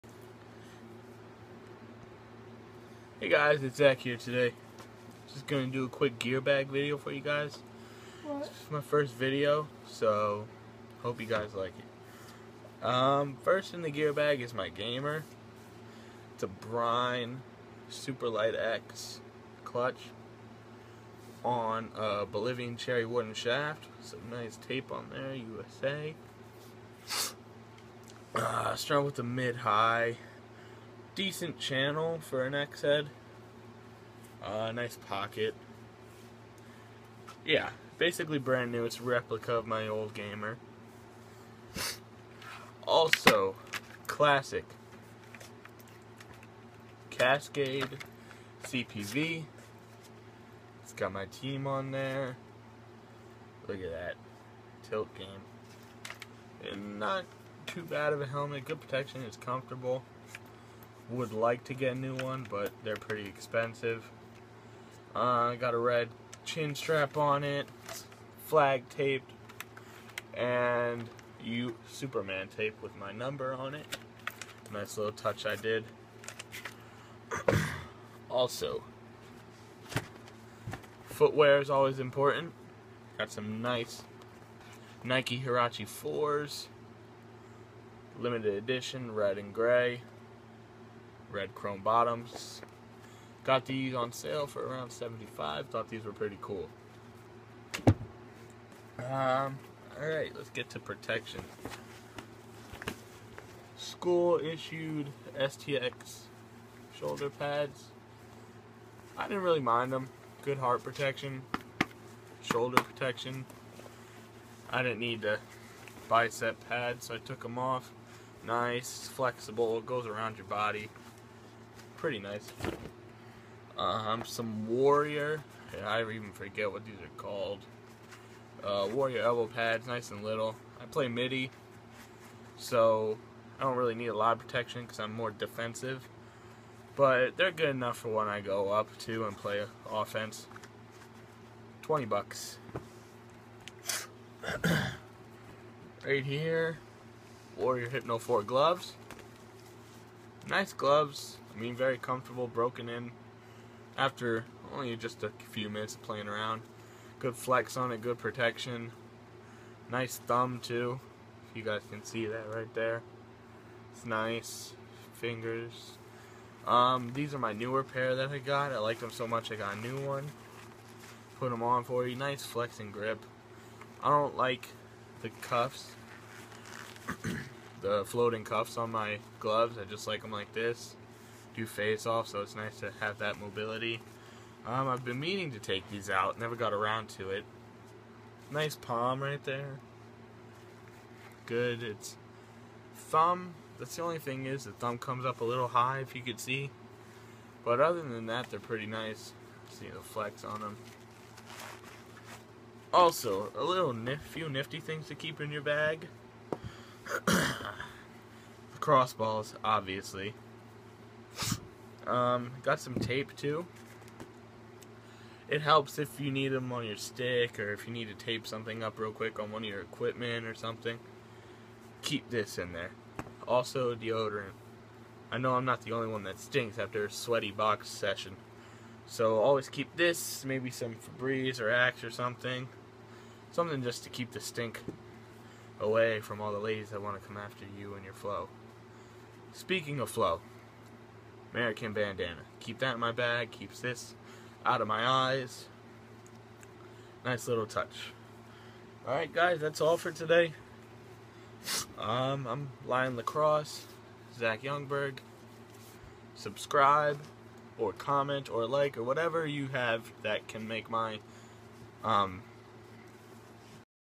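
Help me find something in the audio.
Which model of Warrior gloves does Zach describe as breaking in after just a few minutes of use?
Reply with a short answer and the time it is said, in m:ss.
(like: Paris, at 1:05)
Hypno 4, at 2:27.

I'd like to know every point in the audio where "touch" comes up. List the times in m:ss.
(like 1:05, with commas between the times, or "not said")
1:15, 4:07.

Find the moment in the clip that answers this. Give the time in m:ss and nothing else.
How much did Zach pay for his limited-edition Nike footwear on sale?
1:34.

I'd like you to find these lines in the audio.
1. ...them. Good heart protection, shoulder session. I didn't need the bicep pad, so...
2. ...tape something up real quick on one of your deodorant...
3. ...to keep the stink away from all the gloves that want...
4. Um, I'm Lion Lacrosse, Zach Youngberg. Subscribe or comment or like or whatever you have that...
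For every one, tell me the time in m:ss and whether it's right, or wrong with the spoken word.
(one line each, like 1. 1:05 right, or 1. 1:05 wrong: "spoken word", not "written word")
1. 1:49 wrong: "protection", not "session"
2. 3:38 wrong: "equipment", not "deodorant"
3. 3:54 wrong: "ladies", not "gloves"
4. 4:11 right.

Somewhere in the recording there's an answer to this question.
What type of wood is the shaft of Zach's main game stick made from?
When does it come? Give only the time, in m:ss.
0:22.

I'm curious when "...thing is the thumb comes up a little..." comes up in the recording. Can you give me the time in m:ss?
3:14.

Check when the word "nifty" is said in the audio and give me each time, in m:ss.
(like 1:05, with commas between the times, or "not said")
3:24.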